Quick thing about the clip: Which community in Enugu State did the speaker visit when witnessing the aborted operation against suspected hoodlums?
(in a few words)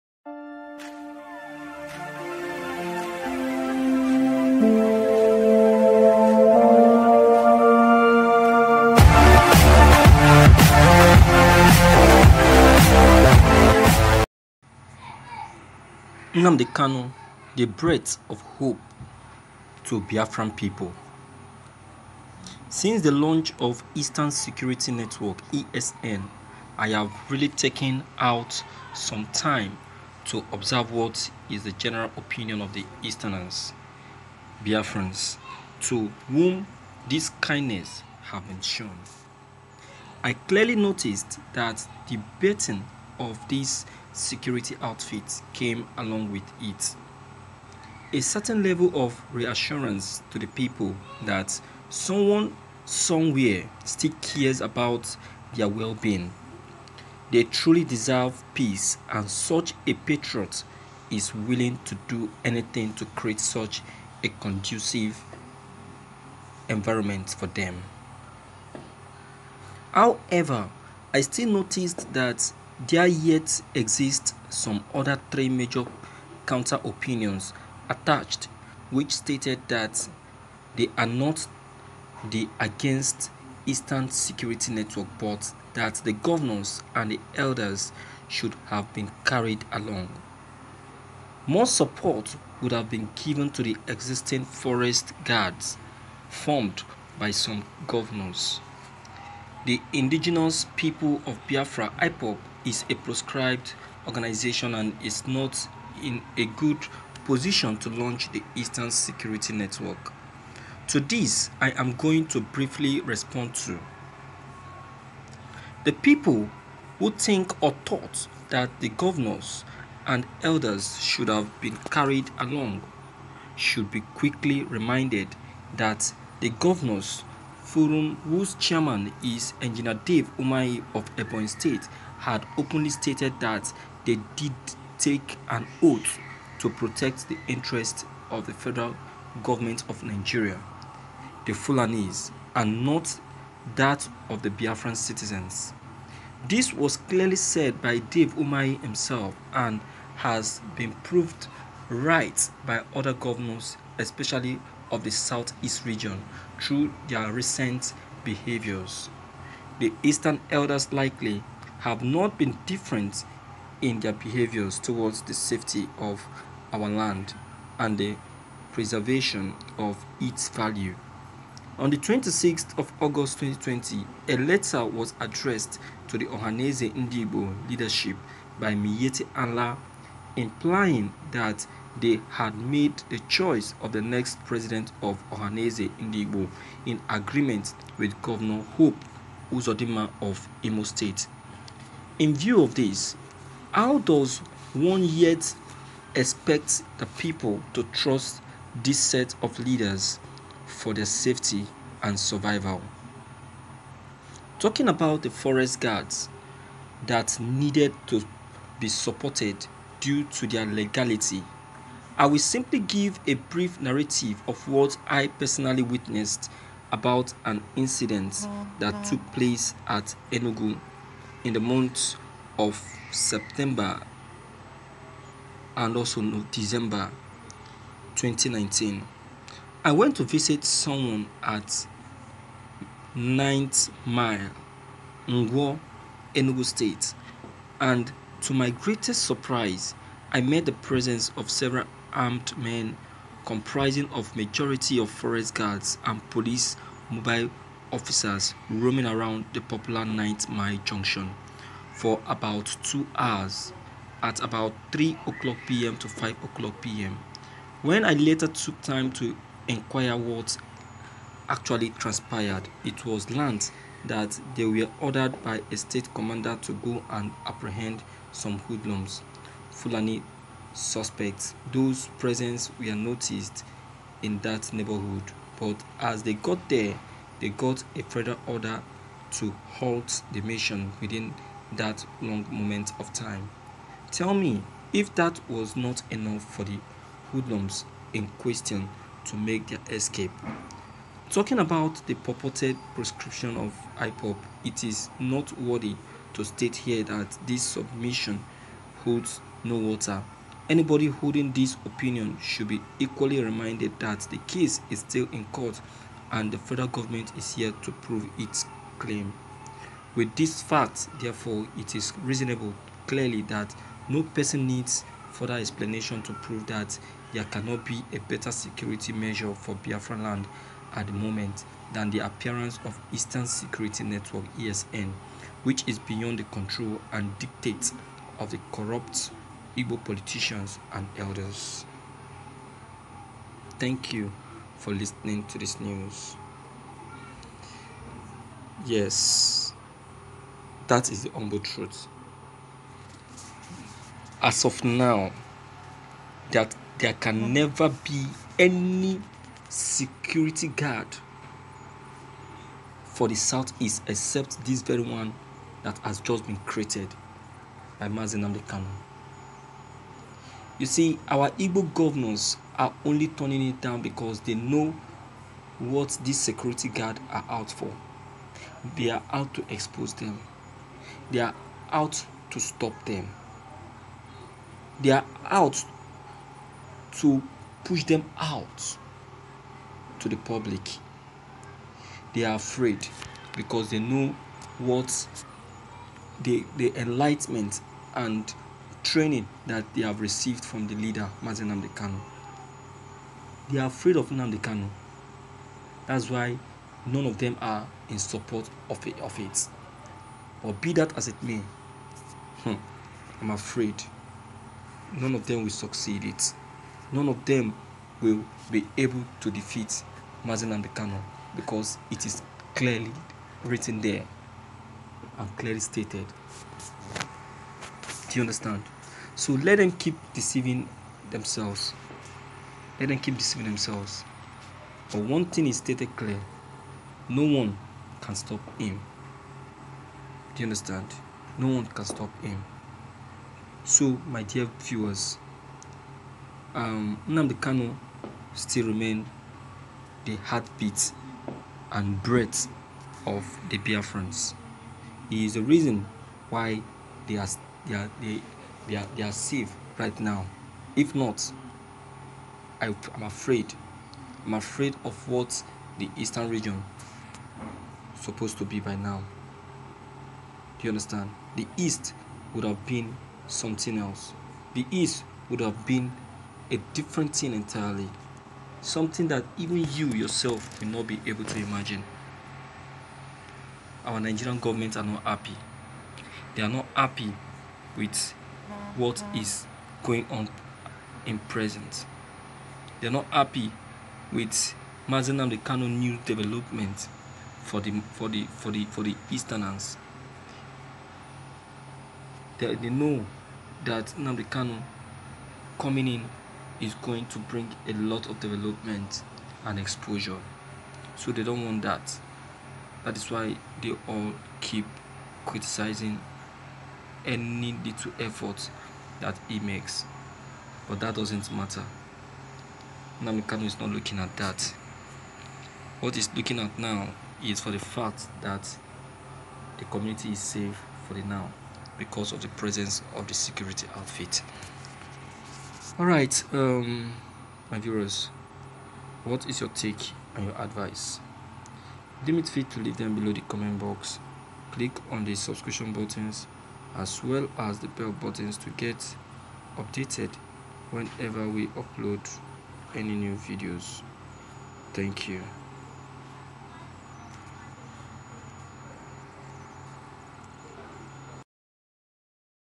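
Ngwo.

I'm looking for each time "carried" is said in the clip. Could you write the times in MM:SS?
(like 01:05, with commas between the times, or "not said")
01:29, 02:01.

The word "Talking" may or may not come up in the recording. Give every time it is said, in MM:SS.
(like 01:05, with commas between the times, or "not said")
03:24, 04:51.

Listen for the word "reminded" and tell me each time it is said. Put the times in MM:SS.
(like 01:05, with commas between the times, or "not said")
02:04, 05:03.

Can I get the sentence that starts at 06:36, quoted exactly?
That's why none of them are in support of it.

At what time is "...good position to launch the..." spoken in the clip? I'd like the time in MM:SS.
01:46.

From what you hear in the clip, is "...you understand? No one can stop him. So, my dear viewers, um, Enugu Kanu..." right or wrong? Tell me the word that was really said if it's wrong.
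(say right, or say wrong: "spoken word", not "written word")
wrong: "Nnamdi", not "Enugu".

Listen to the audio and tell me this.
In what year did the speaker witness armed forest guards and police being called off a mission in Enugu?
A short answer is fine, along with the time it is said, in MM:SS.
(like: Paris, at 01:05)
2019, at 03:48.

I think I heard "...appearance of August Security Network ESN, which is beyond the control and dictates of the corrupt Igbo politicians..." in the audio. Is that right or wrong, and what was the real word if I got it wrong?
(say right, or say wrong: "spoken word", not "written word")
wrong: "Eastern", not "August".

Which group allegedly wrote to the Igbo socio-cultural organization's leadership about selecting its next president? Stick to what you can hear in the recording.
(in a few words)
Miyetti Allah.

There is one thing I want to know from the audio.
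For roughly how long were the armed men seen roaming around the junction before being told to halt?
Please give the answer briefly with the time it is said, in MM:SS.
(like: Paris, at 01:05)
2 hours, at 04:12.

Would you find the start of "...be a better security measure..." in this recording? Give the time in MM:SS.
05:17.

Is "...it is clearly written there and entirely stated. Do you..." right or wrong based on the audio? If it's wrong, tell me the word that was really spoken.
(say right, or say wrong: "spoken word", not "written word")
wrong: "clearly", not "entirely".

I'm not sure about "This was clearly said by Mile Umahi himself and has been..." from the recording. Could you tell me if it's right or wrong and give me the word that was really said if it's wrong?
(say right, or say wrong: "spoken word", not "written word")
wrong: "Dave", not "Mile".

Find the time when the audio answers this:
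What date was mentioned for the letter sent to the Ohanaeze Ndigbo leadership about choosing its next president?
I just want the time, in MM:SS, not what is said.
02:51.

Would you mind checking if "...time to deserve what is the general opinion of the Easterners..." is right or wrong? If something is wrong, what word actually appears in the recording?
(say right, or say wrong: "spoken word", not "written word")
wrong: "observe", not "deserve".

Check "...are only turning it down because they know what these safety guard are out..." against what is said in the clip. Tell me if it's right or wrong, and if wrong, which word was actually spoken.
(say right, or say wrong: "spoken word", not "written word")
wrong: "security", not "safety".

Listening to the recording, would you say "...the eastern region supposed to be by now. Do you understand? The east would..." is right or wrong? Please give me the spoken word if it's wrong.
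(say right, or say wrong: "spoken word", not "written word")
right.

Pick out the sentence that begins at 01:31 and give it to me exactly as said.
More support would have been given to the existing forest guards formed by some governors.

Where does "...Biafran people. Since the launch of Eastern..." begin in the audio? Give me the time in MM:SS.
00:20.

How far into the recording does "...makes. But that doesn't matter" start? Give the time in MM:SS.
08:29.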